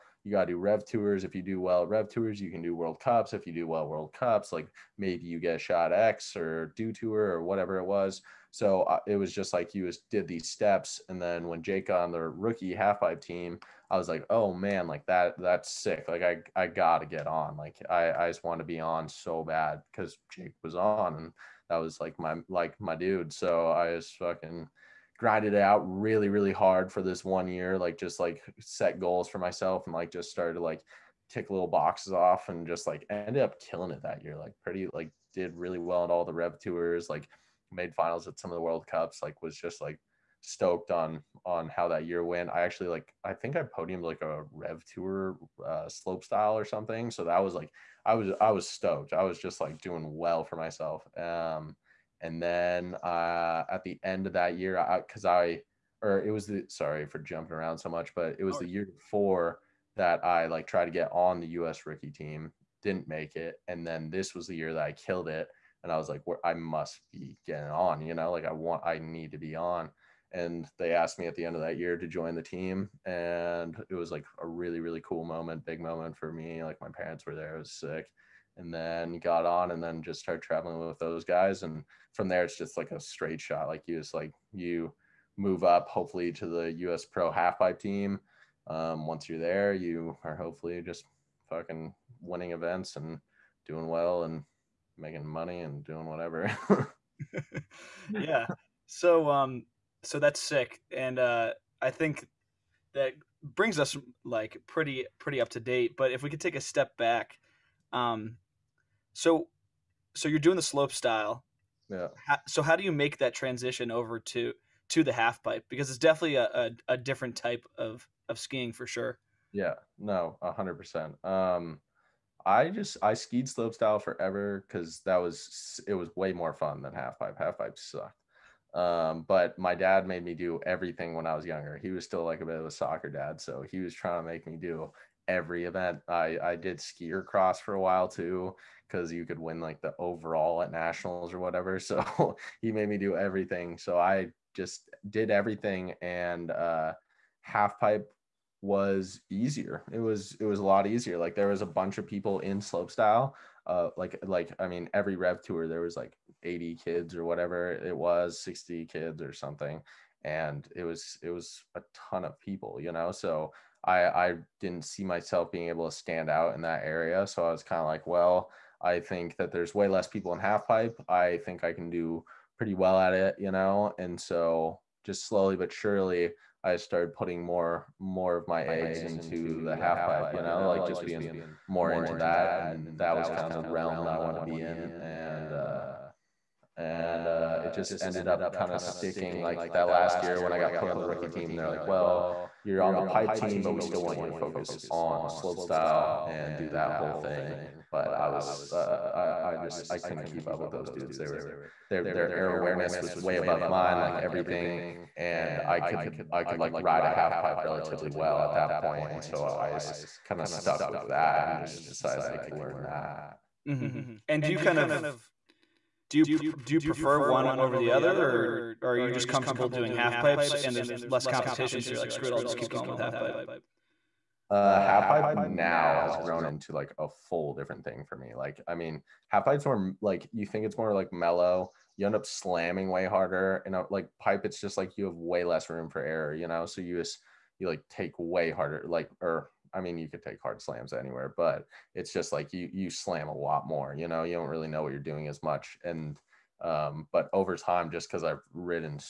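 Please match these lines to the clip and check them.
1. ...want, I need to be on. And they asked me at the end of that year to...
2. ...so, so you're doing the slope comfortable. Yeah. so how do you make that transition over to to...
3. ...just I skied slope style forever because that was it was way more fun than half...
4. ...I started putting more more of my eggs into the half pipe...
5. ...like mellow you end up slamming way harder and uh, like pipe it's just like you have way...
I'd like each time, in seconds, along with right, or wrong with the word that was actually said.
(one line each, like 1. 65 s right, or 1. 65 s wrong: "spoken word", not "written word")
1. 68 s right
2. 109 s wrong: "style", not "comfortable"
3. 122 s right
4. 176 s right
5. 230 s right.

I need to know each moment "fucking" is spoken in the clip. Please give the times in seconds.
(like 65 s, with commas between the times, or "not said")
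24 s, 91 s.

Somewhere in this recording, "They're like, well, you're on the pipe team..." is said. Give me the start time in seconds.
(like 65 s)
191 s.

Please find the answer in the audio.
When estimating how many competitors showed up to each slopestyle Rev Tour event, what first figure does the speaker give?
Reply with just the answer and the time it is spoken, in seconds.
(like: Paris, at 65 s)
80, at 156 s.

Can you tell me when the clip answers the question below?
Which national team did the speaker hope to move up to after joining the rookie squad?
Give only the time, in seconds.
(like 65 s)
86 s.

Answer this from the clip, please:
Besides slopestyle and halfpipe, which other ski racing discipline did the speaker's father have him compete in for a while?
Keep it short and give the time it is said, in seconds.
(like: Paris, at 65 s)
Skier cross, at 136 s.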